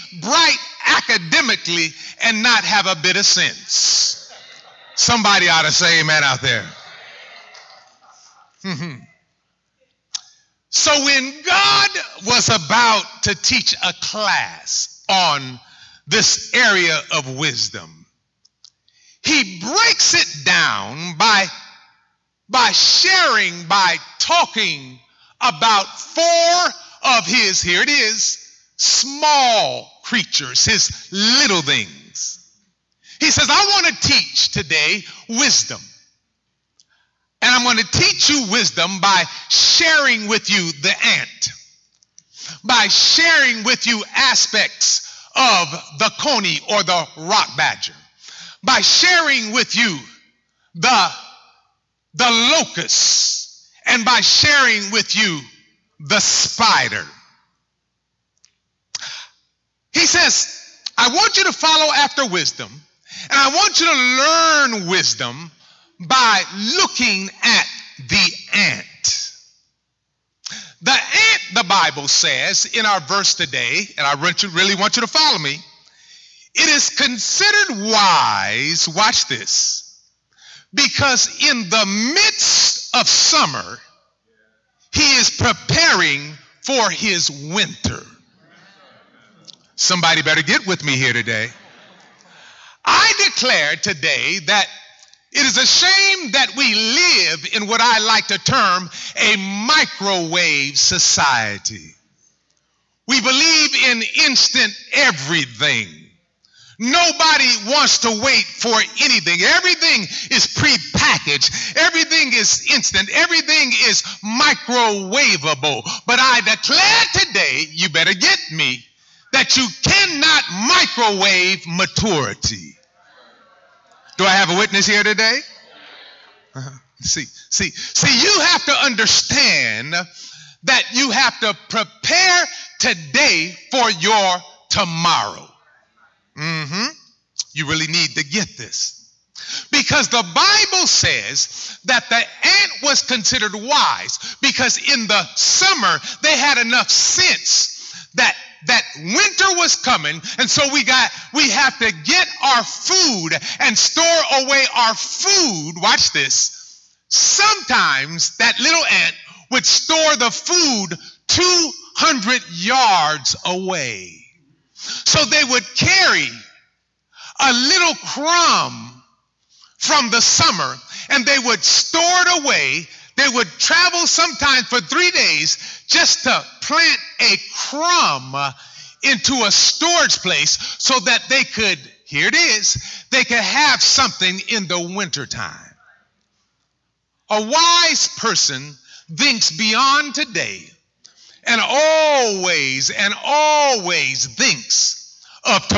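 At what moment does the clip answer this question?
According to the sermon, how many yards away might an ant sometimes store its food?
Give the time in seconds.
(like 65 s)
161 s.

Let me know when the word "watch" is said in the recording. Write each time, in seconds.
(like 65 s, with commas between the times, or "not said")
78 s, 155 s.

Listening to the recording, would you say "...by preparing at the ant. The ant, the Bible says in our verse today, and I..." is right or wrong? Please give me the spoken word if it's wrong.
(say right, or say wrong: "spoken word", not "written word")
wrong: "looking", not "preparing".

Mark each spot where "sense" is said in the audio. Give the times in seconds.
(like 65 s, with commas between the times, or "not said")
3 s, 146 s.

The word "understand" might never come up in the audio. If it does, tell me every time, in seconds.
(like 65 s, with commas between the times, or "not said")
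128 s.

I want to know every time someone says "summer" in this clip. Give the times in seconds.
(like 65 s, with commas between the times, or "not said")
83 s, 145 s, 170 s.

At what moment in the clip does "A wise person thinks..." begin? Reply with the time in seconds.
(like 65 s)
187 s.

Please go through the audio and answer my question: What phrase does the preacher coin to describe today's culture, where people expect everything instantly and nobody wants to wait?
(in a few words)
Microwave society.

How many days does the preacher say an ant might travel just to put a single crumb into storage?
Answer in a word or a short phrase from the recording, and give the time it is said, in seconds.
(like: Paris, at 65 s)
3, at 174 s.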